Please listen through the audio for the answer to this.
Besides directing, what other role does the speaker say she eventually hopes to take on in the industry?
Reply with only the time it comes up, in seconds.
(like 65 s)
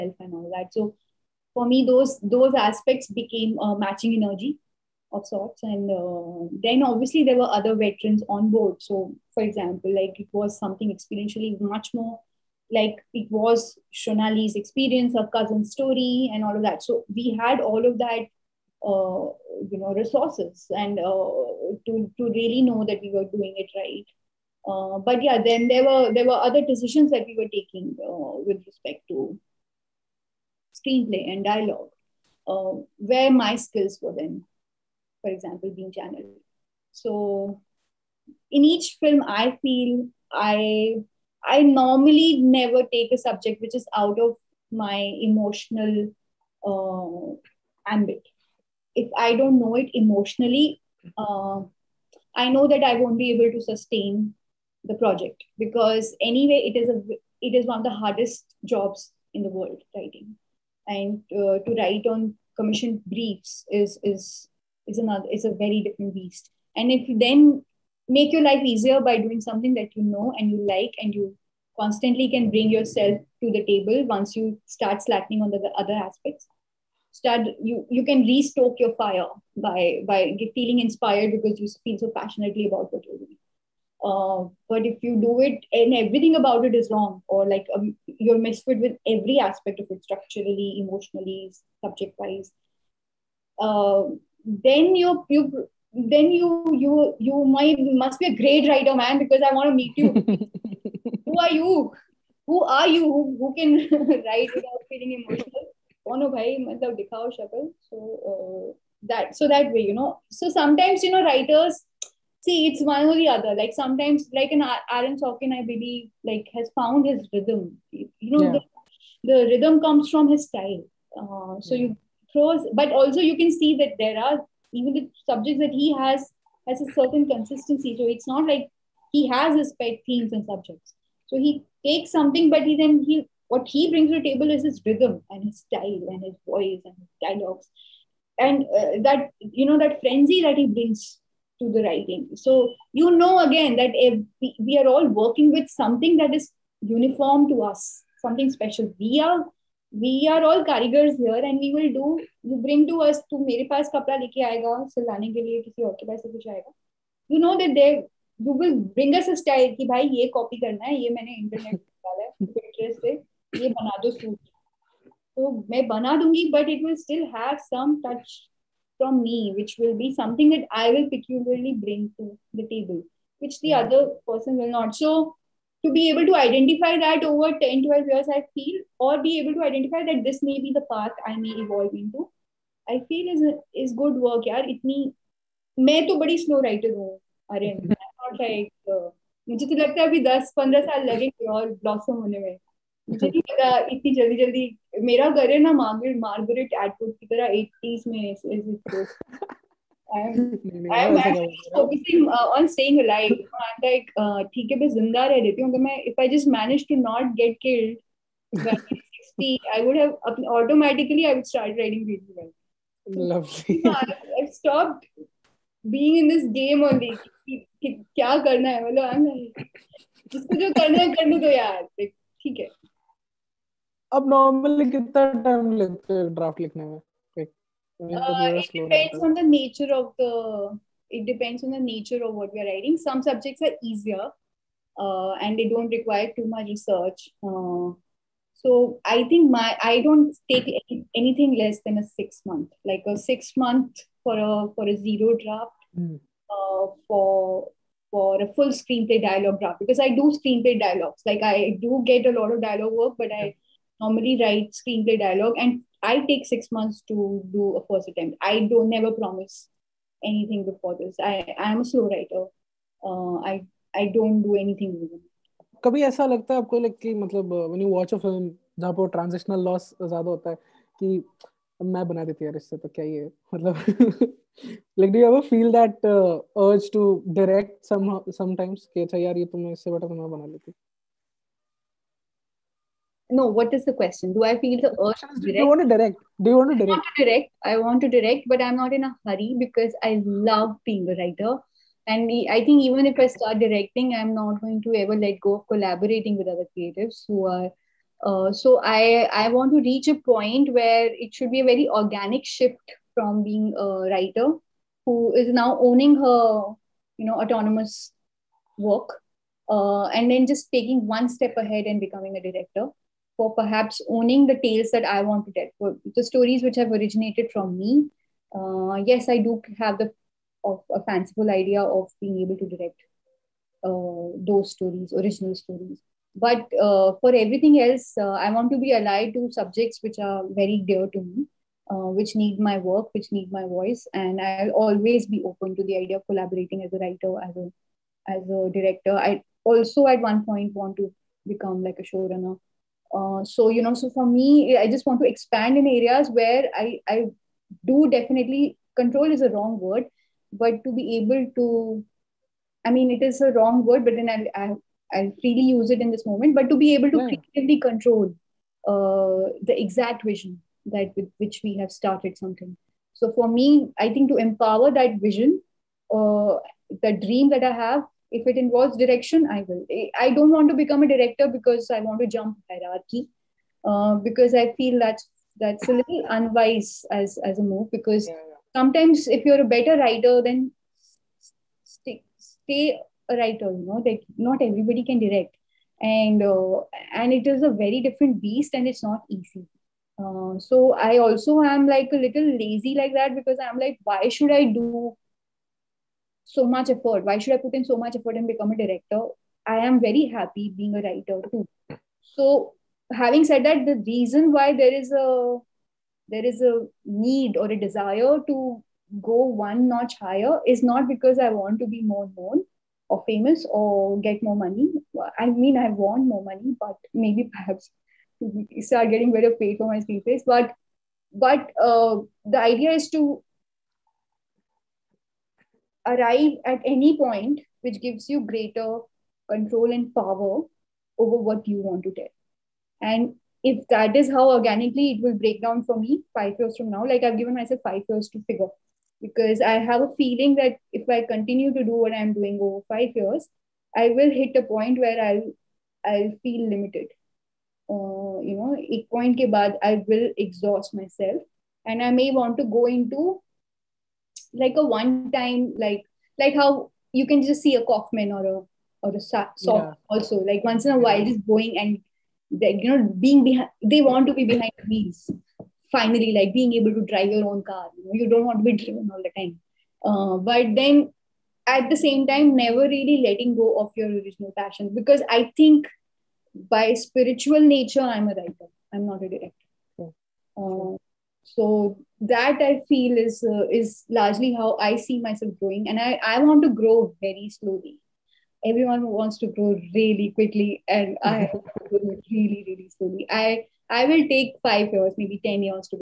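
342 s.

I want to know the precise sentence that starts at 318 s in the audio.
Uh, yes, I do have the of a fanciful idea of being able to direct uh, those stories, original stories.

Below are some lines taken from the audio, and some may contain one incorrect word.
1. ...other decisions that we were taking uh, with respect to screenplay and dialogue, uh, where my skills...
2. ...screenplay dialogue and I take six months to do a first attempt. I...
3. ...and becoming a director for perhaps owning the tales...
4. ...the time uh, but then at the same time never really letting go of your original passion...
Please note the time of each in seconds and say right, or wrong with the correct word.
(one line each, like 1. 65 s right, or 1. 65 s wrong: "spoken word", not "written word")
1. 26 s right
2. 254 s right
3. 311 s right
4. 469 s right.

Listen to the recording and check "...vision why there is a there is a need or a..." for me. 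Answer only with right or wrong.
wrong.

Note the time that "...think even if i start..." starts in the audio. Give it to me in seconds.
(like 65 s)
292 s.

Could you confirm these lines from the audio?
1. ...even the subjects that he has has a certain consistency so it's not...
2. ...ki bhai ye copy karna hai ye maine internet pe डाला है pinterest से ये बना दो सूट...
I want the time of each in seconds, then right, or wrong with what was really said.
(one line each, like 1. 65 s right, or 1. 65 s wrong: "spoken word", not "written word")
1. 124 s right
2. 159 s right.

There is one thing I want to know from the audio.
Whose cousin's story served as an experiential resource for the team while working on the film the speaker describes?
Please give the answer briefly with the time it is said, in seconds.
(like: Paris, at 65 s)
Shonali, at 13 s.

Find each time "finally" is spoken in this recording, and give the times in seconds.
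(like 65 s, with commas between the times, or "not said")
465 s.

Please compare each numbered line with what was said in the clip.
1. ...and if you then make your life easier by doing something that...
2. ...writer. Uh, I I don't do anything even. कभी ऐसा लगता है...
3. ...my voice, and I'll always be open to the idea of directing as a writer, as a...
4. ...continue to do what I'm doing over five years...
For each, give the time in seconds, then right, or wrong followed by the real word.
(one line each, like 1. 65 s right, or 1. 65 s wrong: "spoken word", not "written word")
1. 66 s right
2. 262 s right
3. 333 s wrong: "collaborating", not "directing"
4. 441 s right.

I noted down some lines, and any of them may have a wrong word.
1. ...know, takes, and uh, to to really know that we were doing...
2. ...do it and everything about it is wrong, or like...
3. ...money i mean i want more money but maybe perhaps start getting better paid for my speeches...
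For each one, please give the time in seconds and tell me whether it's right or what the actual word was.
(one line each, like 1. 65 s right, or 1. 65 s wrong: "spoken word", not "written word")
1. 19 s wrong: "resources", not "takes"
2. 85 s right
3. 414 s right.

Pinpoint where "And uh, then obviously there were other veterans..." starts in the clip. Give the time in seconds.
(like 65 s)
5 s.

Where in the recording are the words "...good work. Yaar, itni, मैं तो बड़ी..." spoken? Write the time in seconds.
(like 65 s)
184 s.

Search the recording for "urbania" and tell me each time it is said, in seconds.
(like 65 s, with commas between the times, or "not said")
not said.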